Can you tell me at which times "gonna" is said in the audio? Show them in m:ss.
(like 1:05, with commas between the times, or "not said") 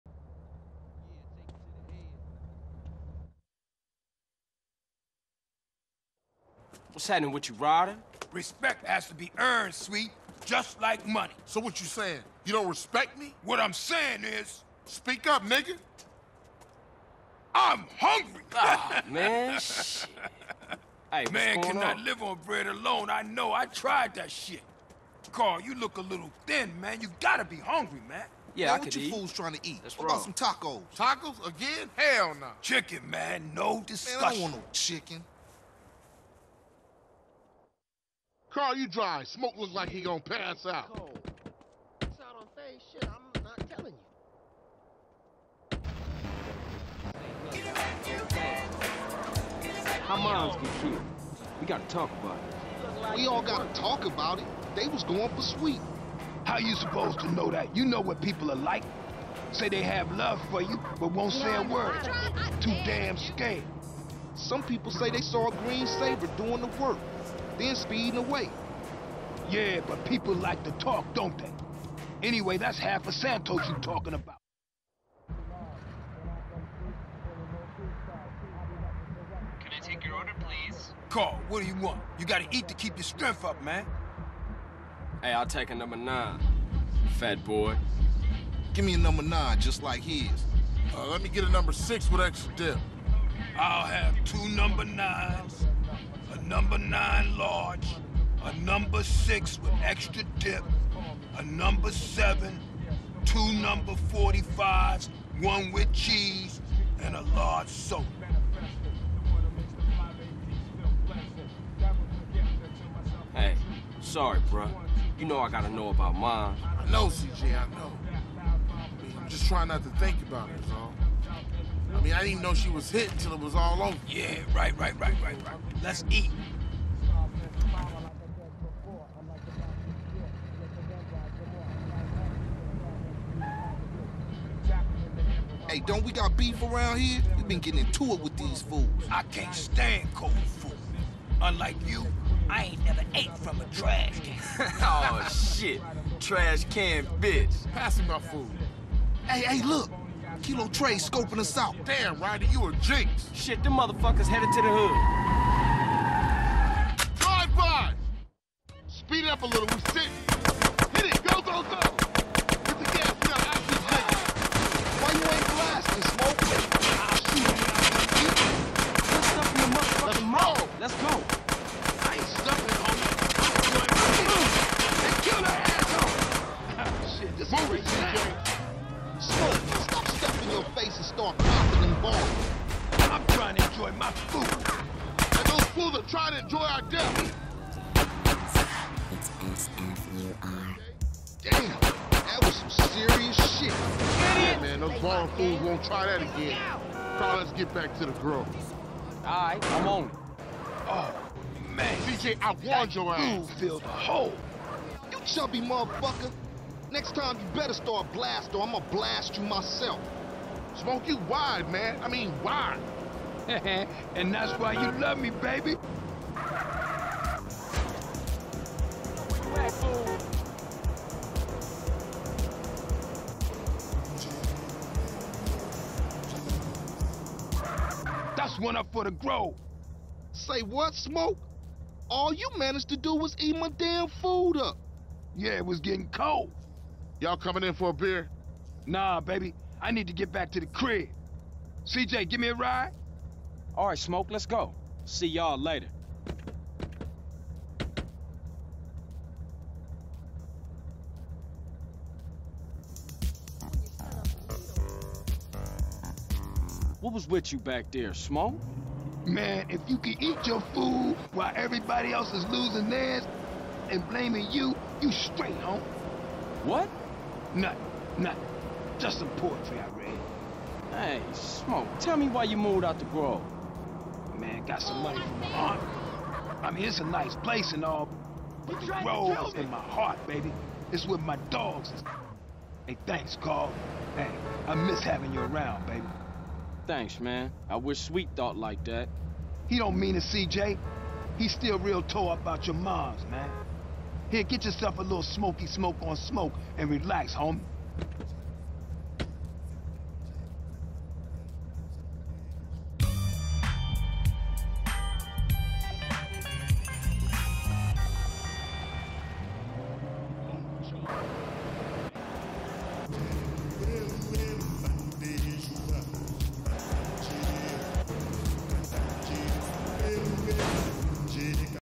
0:40, 3:28.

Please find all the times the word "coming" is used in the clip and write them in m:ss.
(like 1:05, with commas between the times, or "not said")
3:57.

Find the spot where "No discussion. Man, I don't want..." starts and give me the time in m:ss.
0:33.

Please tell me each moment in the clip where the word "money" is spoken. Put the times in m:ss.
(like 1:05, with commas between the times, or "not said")
0:11, 4:35.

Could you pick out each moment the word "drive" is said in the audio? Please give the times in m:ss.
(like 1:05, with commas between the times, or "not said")
0:38, 2:37.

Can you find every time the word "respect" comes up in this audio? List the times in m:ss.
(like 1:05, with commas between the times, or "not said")
0:08, 0:12.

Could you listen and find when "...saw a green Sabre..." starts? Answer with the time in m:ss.
1:05.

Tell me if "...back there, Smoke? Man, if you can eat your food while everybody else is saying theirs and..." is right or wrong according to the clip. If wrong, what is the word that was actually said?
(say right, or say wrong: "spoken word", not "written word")
wrong: "losing", not "saying".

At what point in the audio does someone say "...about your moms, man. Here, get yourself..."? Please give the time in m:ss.
4:52.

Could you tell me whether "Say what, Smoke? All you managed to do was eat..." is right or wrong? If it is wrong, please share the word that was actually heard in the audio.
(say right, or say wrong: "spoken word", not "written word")
right.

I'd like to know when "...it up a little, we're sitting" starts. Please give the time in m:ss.
2:39.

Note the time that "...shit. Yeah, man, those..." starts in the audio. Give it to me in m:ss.
3:13.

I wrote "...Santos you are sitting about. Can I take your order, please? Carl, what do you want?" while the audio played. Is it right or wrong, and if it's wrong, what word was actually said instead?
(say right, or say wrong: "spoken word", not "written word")
wrong: "talking", not "sitting".